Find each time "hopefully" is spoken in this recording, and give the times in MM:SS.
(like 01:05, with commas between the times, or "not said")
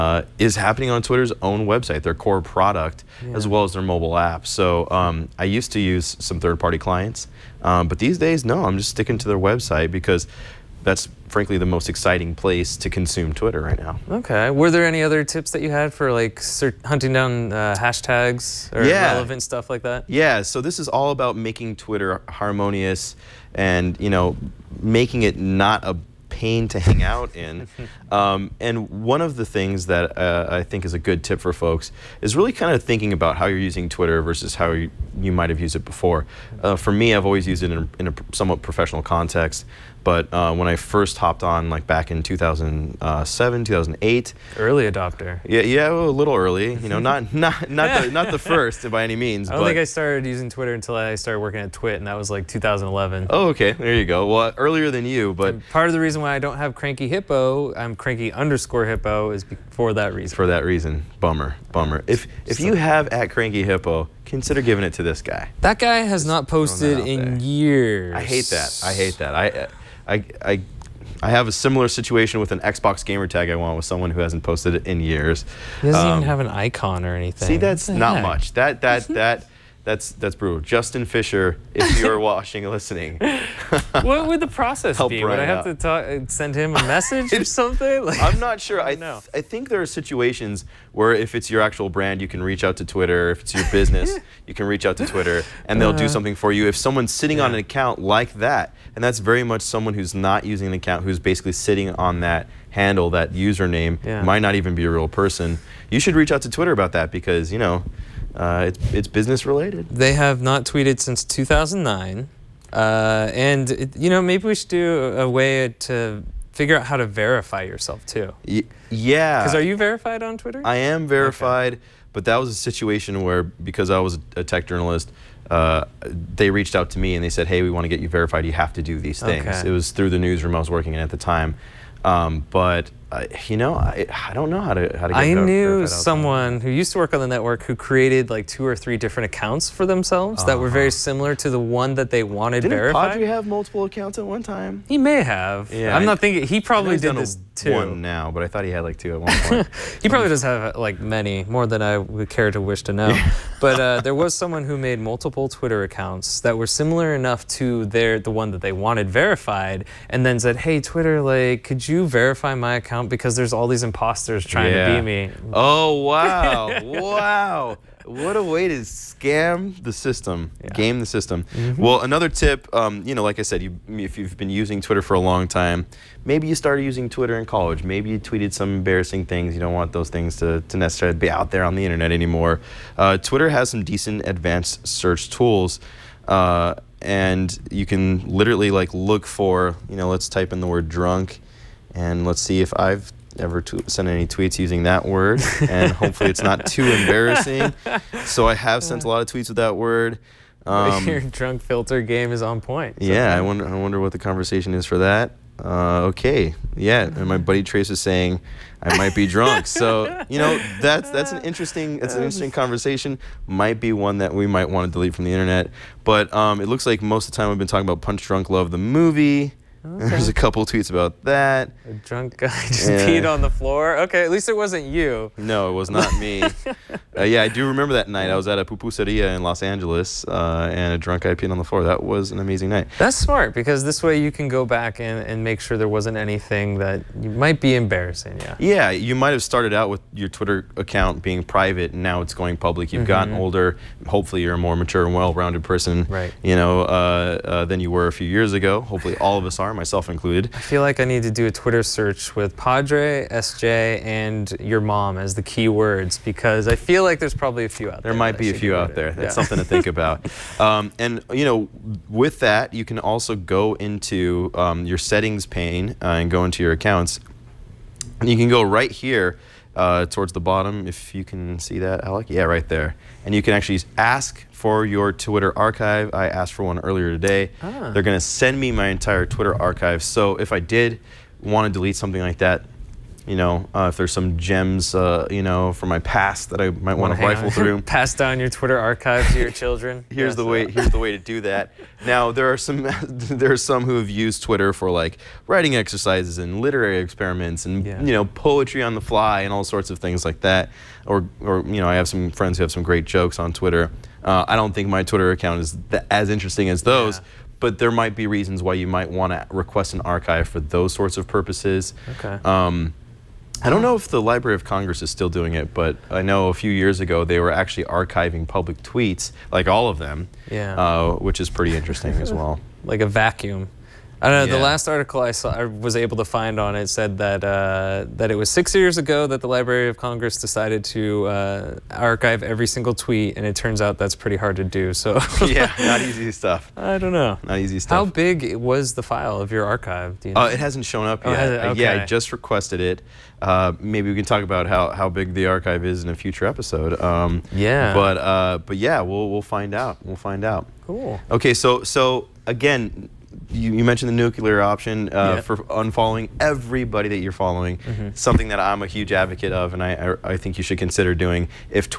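03:15, 04:04, 04:08.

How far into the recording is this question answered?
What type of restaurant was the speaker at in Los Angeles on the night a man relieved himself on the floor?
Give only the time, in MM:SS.
03:48.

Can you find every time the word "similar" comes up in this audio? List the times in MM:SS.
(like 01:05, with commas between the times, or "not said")
01:11, 02:21, 02:36.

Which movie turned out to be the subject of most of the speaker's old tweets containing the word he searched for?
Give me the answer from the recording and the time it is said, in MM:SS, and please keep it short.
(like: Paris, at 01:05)
Punch Drunk Love, at 03:38.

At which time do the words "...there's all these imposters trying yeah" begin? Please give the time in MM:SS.
02:43.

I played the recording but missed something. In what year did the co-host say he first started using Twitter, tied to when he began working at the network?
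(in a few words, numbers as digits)
2011.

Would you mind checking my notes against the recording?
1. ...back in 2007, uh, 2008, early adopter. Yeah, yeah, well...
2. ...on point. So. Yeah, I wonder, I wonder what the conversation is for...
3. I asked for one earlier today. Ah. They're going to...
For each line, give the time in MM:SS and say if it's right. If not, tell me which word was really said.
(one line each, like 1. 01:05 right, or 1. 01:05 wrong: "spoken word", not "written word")
1. 00:41 right
2. 03:22 right
3. 04:36 right.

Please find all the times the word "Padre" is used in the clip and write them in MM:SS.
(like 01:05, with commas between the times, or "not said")
02:23, 04:12.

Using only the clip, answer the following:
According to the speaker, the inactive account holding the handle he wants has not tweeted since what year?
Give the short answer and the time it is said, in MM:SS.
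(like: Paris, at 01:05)
2009, at 01:51.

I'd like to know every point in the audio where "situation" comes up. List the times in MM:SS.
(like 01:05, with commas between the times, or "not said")
01:11, 01:29, 02:02.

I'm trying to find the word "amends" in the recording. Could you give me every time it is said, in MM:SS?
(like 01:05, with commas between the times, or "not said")
not said.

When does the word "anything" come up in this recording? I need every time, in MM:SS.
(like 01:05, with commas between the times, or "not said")
01:17, 03:56.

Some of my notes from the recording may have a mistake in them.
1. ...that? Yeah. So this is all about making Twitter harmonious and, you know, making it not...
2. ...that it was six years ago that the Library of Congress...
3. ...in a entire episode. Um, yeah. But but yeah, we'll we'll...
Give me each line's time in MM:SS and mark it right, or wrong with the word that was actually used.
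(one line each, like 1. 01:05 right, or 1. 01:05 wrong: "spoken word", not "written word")
1. 00:19 right
2. 05:28 right
3. 05:46 wrong: "future", not "entire".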